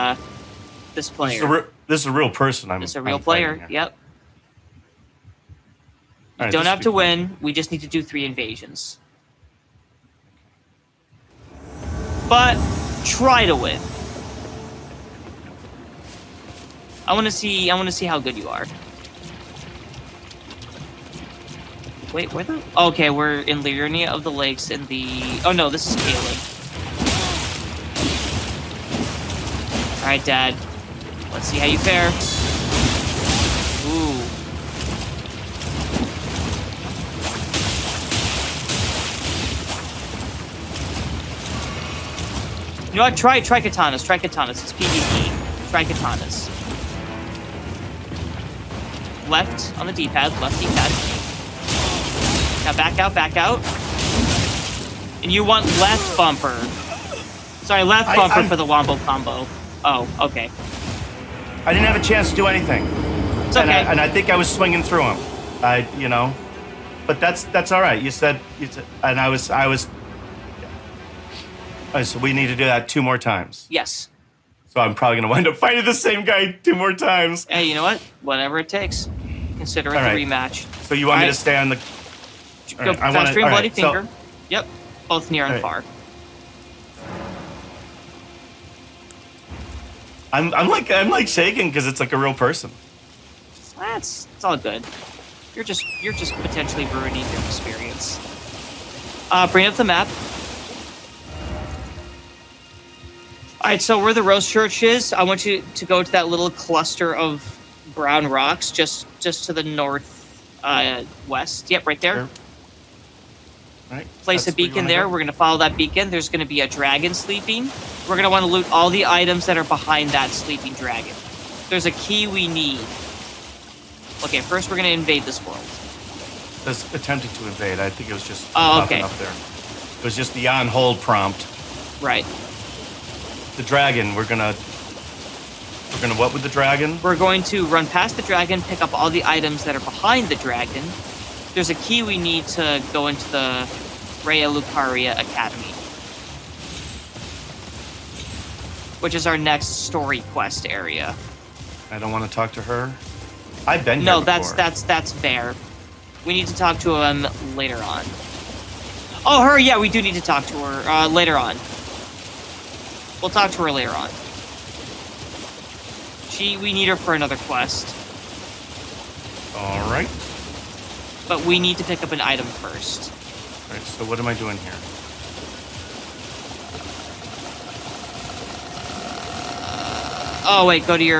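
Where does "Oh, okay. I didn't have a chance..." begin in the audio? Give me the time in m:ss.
0:59.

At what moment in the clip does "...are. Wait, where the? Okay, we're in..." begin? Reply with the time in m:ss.
0:18.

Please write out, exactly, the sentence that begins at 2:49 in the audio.
All right but we need to pick up an item first.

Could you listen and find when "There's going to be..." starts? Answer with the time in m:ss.
1:56.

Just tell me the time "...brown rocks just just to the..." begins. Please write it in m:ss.
1:47.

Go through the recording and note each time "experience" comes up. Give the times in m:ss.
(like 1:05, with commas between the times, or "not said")
1:37.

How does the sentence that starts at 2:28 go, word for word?
Which is our next story quest area.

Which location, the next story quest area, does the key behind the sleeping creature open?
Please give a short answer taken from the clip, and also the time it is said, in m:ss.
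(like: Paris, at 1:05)
Raya Lucaria Academy, at 2:24.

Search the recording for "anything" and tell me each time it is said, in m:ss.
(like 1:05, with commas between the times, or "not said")
1:02.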